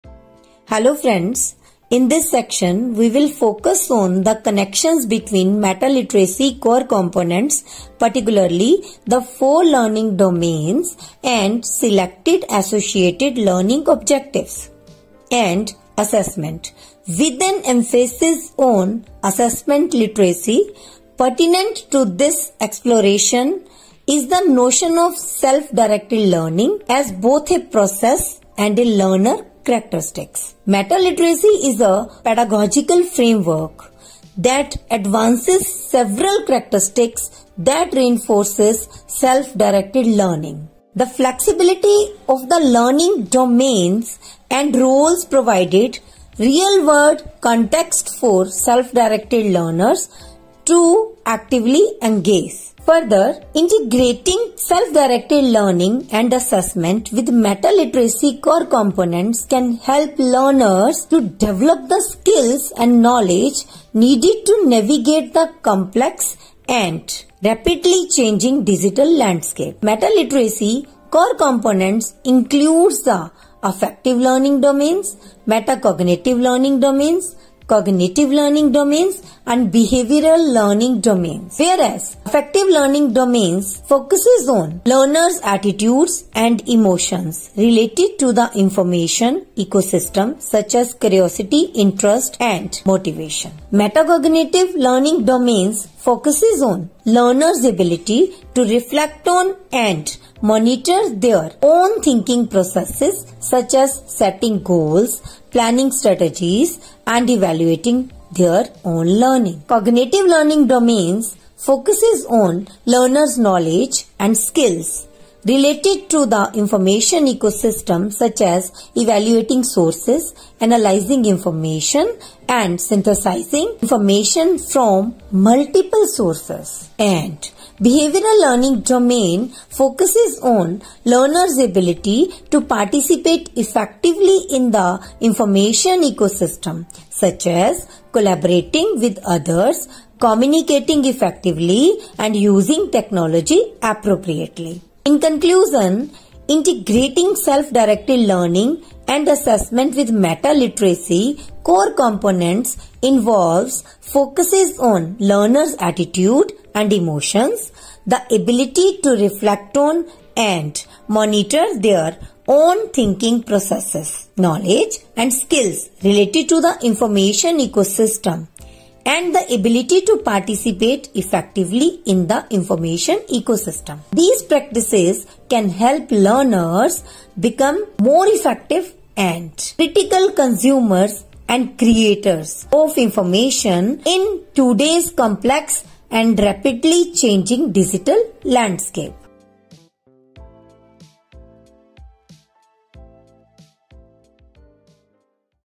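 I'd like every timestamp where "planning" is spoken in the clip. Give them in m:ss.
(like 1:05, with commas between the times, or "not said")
1:45.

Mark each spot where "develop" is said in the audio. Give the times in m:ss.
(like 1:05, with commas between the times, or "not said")
1:01.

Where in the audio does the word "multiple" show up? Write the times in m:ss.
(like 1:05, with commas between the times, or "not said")
2:05.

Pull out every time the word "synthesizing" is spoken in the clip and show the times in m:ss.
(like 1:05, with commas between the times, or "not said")
2:02.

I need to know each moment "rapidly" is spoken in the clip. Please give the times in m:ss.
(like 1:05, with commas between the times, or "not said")
1:07, 3:06.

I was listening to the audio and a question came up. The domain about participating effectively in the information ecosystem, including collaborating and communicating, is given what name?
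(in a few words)
Behavioral learning domain.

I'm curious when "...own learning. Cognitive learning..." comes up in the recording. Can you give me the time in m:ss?
1:48.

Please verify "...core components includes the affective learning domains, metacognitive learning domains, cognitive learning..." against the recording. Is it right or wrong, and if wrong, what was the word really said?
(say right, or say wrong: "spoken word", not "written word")
right.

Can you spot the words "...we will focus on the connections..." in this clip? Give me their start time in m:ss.
0:02.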